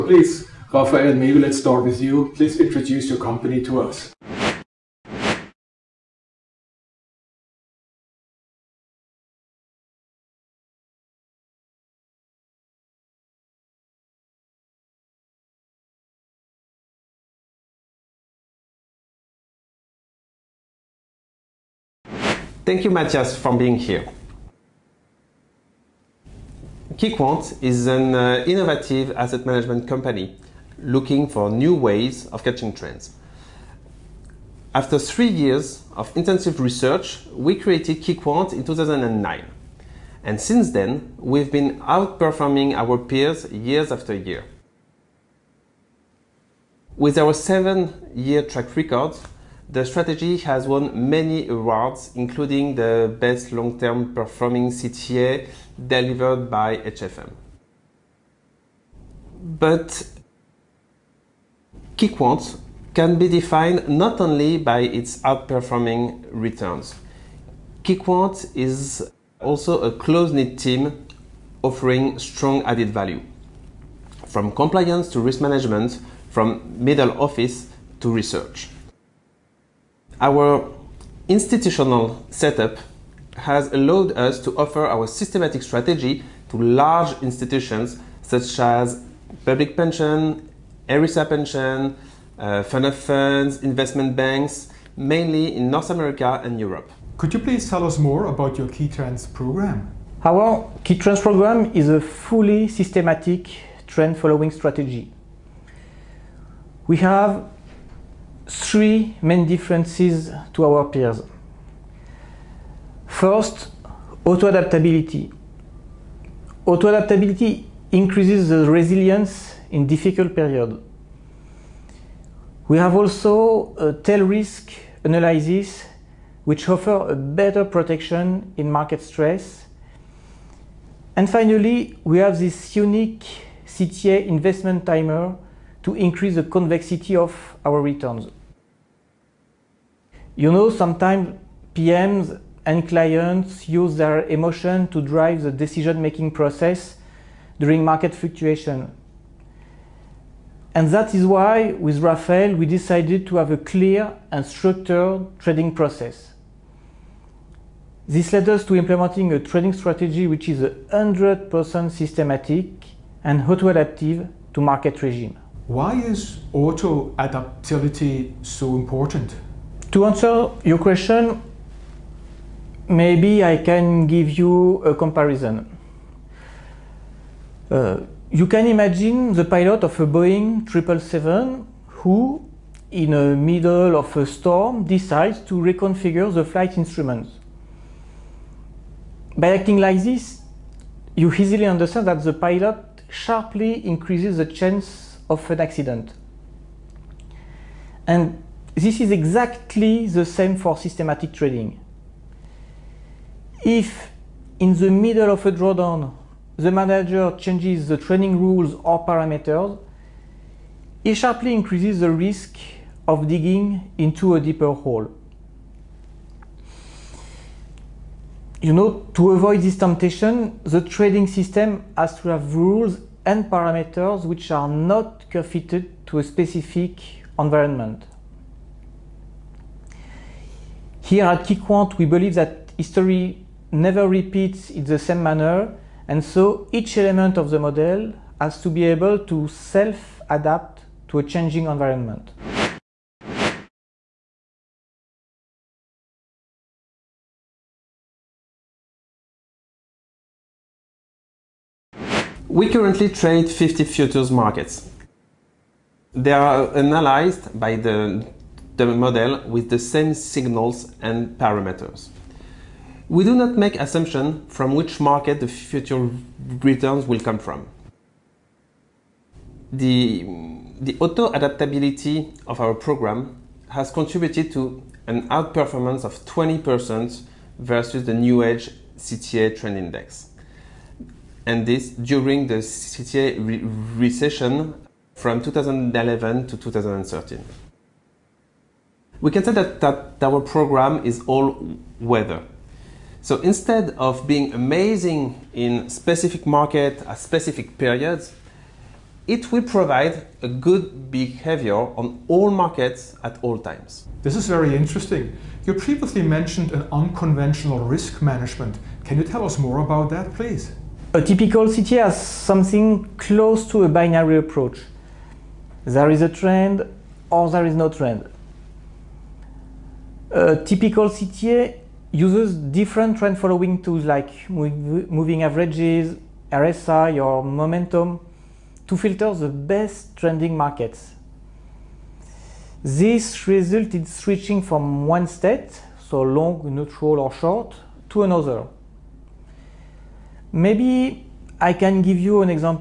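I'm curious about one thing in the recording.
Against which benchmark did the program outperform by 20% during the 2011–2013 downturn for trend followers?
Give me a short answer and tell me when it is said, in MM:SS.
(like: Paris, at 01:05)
Newedge CTA Trend Index, at 04:38.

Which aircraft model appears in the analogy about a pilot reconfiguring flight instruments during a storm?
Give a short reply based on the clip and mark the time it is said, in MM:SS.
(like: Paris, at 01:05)
Boeing 777, at 03:00.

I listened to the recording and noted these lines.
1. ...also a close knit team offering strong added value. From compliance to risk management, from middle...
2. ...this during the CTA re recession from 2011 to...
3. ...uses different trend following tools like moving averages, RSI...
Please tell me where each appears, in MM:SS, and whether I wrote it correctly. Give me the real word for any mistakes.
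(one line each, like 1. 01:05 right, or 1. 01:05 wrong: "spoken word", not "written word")
1. 01:09 right
2. 04:41 right
3. 05:22 right.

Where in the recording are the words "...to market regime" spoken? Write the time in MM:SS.
02:44.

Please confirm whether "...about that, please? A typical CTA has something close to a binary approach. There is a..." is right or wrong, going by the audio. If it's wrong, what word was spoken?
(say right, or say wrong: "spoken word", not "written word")
right.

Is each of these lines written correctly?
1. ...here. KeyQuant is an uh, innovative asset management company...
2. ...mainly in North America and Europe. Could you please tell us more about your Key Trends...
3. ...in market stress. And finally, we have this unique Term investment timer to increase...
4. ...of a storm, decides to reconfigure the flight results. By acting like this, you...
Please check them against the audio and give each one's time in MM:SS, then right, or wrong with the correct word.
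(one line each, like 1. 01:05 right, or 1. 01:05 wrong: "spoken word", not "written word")
1. 00:23 right
2. 01:34 right
3. 02:08 wrong: "CTA", not "Term"
4. 03:03 wrong: "instruments", not "results".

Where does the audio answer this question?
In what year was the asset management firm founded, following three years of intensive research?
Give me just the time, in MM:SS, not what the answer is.
00:38.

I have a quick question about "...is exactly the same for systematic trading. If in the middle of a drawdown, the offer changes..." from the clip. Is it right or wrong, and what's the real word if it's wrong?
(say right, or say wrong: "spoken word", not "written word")
wrong: "manager", not "offer".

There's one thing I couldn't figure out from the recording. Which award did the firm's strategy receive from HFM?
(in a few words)
Best Long Term Performing CTA.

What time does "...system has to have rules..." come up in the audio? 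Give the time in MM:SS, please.
03:41.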